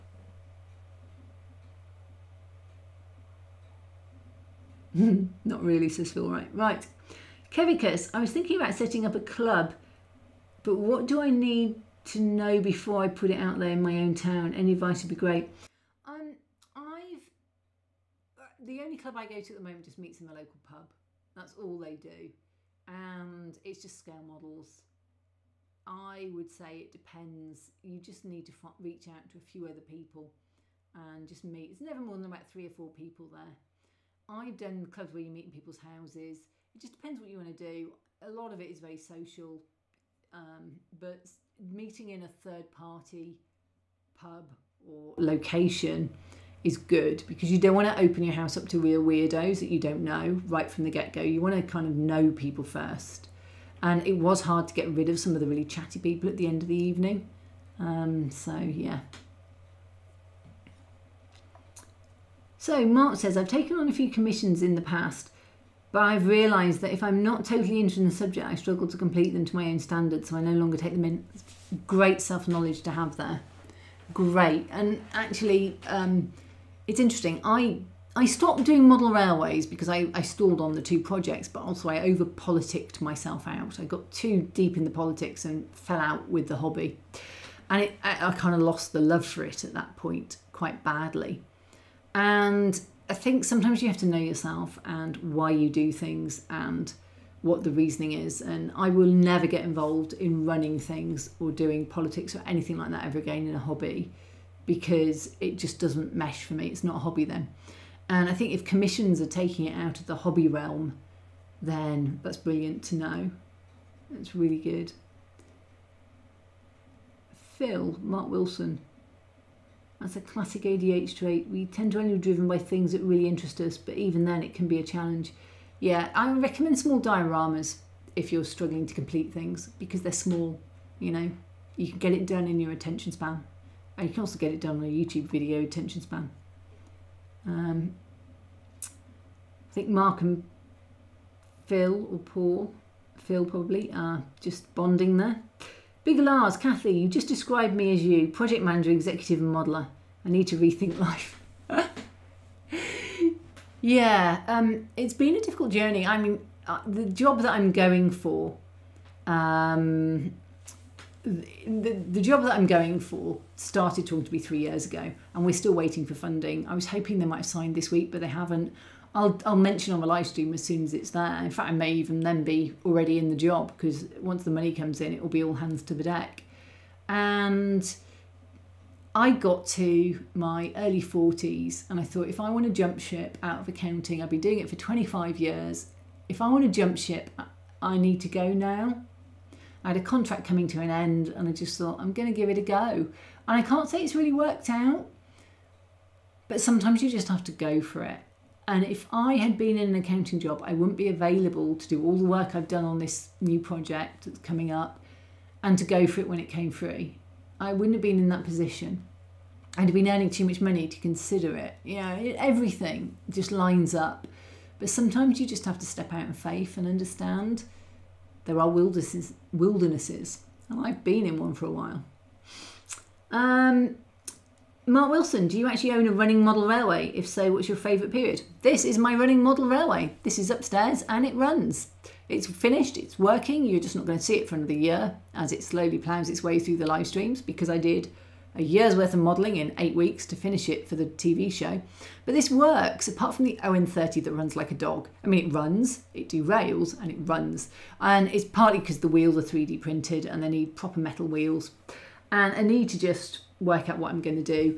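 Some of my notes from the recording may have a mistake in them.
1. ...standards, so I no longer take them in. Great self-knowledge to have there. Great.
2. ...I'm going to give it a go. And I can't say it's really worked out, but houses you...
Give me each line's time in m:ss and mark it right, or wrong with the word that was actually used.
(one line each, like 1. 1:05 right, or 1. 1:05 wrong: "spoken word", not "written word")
1. 1:09 right
2. 3:11 wrong: "sometimes", not "houses".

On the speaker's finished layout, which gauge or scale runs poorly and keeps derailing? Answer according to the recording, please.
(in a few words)
ON30.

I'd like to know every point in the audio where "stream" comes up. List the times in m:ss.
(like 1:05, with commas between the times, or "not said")
2:50, 3:57.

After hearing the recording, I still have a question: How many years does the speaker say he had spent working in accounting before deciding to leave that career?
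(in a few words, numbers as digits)
25.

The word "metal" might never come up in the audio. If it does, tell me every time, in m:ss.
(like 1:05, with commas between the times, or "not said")
4:10.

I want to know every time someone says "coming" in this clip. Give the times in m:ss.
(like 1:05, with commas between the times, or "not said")
3:10, 3:24.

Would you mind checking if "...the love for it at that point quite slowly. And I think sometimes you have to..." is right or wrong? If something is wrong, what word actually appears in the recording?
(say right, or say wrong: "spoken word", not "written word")
wrong: "badly", not "slowly".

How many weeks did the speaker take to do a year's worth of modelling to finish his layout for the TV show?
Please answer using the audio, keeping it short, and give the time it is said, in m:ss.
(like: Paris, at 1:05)
8, at 3:59.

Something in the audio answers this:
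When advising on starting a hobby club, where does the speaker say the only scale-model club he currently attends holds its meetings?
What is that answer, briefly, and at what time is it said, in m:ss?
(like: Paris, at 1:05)
the local pub, at 0:20.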